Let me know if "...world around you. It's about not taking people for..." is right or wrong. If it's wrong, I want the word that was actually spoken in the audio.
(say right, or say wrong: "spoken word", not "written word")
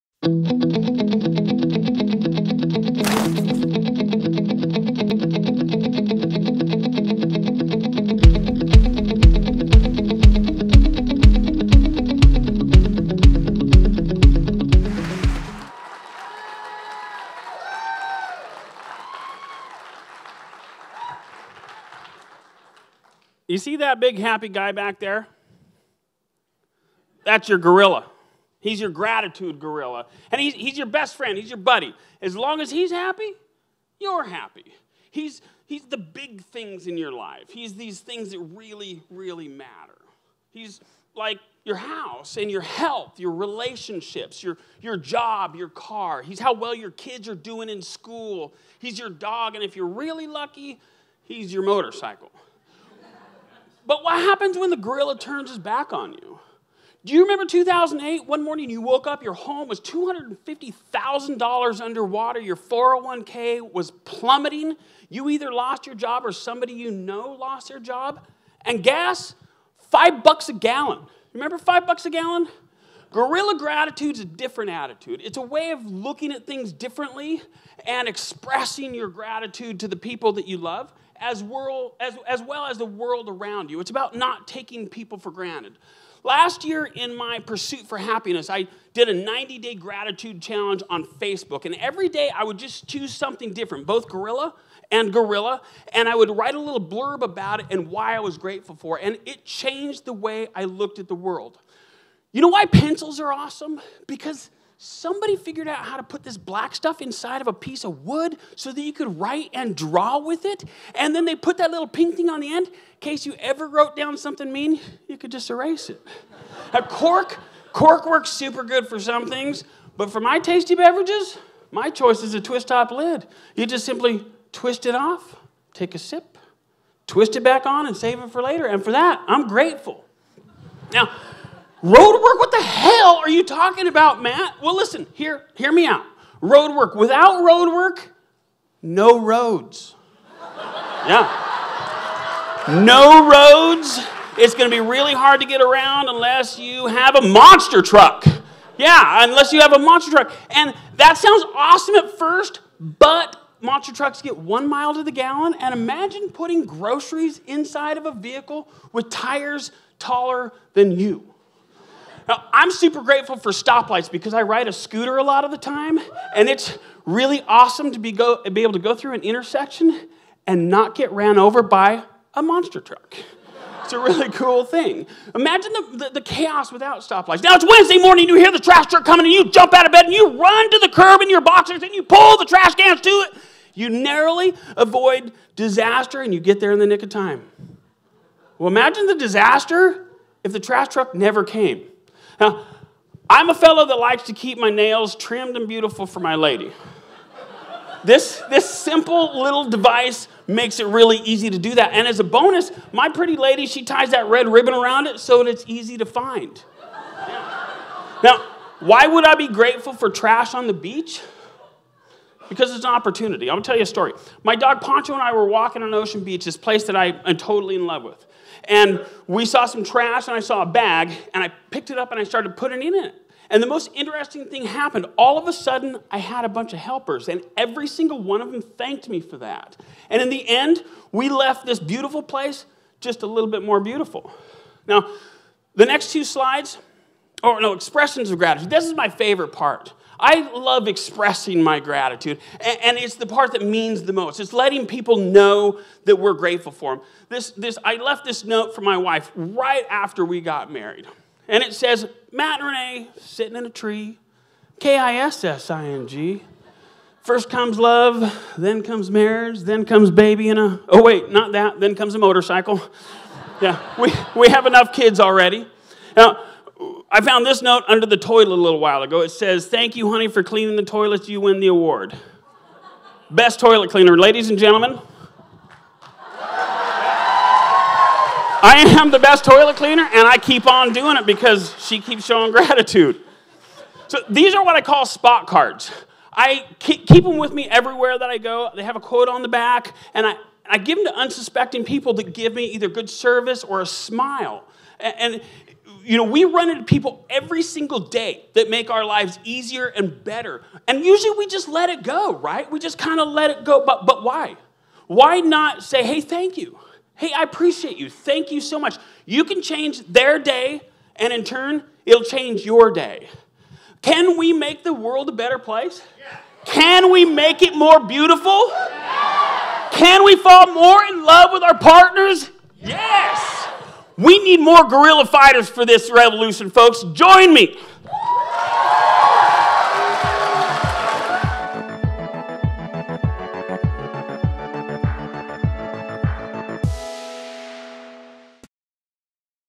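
right.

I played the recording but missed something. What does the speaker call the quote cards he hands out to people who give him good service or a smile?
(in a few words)
spot cards.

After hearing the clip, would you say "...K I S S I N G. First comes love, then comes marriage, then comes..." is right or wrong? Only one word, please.
right.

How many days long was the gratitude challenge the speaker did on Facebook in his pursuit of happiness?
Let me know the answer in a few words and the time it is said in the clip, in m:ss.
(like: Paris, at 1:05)
90, at 1:29.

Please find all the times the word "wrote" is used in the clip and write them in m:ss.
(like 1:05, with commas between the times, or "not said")
1:53.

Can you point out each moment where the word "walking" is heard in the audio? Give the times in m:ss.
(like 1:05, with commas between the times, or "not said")
3:35.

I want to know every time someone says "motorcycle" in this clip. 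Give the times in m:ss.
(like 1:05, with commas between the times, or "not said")
0:51, 4:22.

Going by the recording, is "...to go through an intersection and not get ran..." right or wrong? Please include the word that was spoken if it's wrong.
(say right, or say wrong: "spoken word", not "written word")
right.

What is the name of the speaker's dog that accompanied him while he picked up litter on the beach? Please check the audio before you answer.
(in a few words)
Poncho.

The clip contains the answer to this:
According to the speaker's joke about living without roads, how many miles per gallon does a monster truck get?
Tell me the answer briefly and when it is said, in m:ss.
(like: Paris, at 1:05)
1 mile, at 2:34.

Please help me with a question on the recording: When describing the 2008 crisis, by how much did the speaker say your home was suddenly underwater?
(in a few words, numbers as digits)
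$250,000.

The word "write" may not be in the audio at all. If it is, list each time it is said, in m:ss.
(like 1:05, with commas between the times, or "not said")
1:36, 1:49.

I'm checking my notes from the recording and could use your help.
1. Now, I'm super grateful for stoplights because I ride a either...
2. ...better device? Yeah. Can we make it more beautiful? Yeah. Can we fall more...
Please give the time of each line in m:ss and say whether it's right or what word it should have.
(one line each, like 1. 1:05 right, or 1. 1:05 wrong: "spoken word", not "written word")
1. 2:42 wrong: "scooter", not "either"
2. 5:15 wrong: "place", not "device".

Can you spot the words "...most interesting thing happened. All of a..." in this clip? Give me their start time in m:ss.
3:43.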